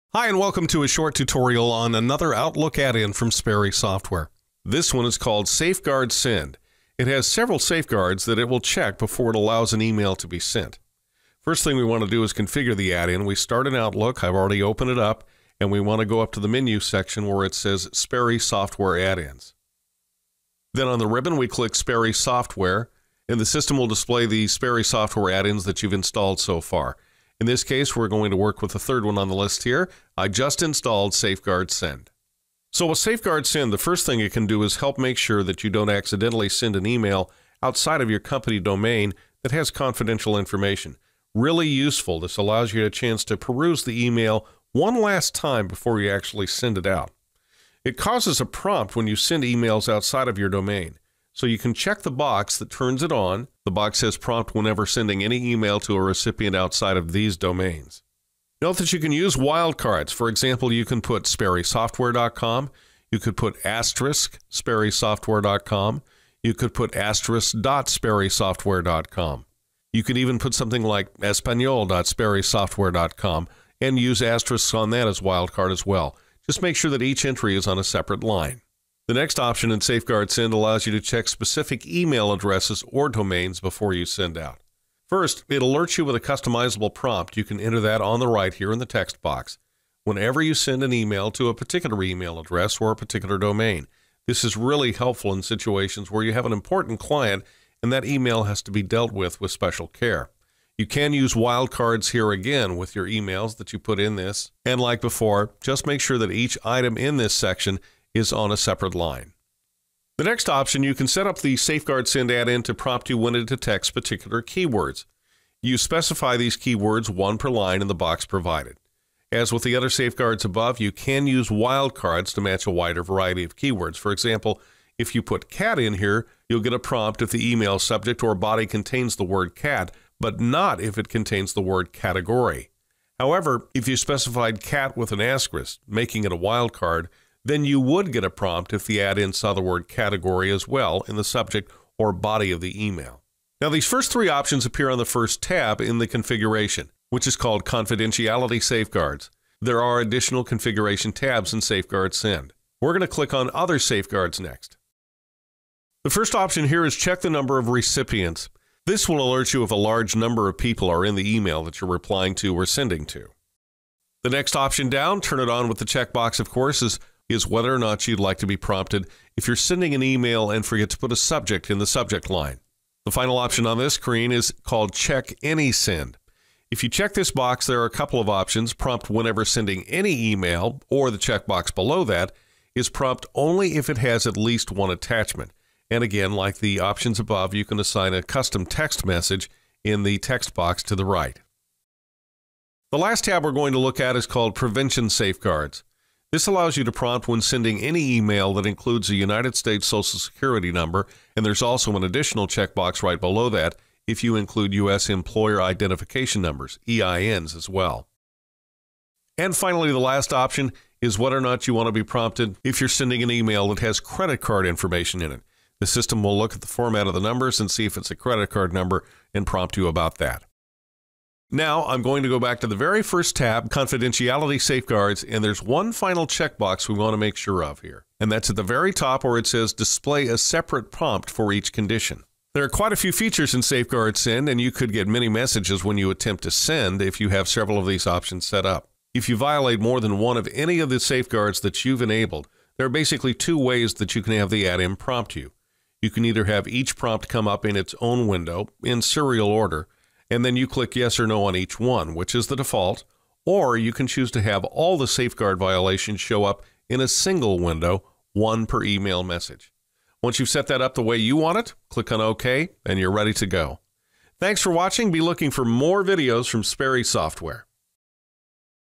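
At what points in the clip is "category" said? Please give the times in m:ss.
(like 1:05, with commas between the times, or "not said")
2:11, 2:19.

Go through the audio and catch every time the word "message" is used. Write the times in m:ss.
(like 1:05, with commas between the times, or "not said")
3:09, 3:55, 4:19.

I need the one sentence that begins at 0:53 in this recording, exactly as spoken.
The box says prompt whenever sending any email to a recipient outside of these domains.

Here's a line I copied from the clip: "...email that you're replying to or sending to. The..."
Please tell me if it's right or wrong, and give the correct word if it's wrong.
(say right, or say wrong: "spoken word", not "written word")
right.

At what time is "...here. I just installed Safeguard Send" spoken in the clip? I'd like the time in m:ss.
0:29.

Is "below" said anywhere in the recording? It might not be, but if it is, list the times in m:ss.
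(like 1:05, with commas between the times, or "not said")
3:01, 3:23.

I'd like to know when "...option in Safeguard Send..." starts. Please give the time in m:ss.
1:19.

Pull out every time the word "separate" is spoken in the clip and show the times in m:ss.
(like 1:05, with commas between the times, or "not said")
1:17, 1:48, 3:50.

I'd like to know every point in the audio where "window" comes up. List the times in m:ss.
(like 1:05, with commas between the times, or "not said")
4:08, 4:17.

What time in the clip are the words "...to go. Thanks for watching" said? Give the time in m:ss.
4:23.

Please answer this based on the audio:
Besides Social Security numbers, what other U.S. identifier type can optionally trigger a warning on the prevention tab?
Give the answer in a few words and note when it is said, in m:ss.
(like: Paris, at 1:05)
Employer Identification Numbers, at 3:25.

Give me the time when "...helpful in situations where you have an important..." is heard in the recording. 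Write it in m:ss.
1:34.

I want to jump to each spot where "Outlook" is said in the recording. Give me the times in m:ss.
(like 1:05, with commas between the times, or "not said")
0:02, 0:13.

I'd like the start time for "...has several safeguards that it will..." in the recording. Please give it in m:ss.
0:07.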